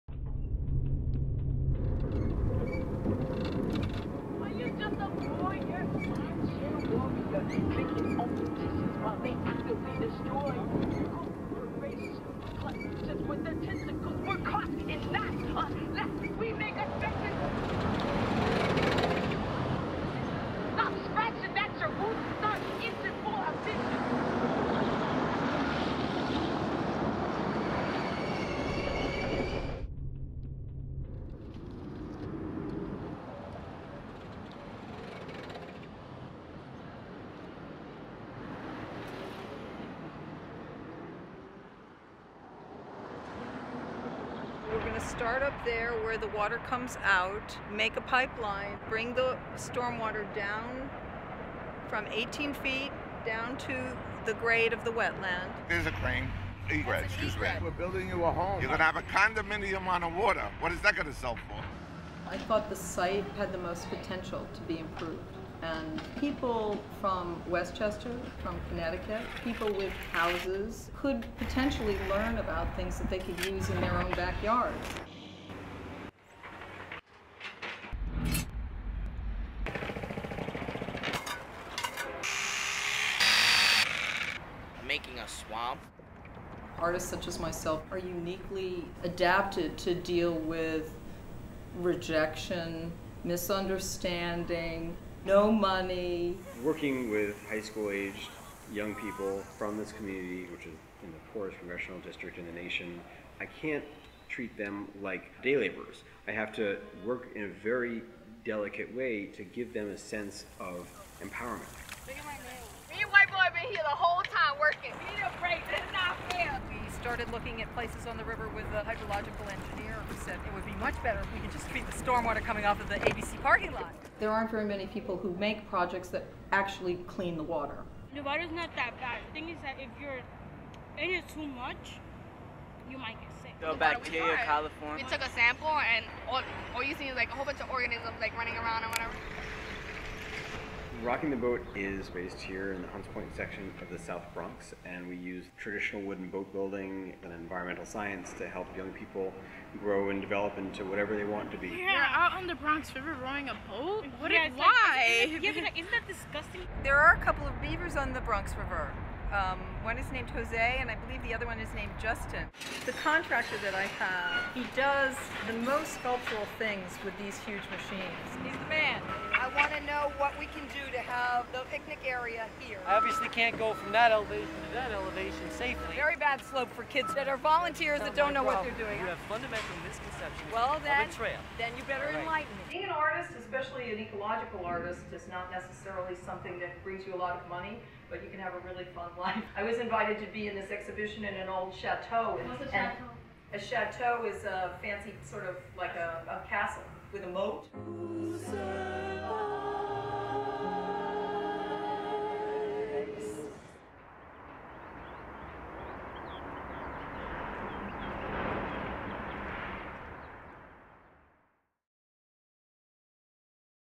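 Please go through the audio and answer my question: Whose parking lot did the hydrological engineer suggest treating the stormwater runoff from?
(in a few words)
ABC.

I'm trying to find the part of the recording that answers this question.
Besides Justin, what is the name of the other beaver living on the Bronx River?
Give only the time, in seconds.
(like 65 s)
160 s.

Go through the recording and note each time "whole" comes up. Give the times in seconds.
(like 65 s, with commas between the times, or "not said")
113 s, 137 s.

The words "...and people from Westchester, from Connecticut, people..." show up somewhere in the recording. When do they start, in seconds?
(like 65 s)
65 s.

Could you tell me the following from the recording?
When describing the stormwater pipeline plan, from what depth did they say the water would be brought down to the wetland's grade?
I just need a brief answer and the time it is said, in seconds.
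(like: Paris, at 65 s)
18 feet, at 52 s.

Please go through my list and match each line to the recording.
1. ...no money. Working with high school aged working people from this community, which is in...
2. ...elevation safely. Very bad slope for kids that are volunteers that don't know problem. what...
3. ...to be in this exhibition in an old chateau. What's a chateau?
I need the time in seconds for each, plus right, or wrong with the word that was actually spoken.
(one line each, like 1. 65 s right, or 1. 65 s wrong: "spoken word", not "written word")
1. 95 s wrong: "young", not "working"
2. 174 s right
3. 190 s right.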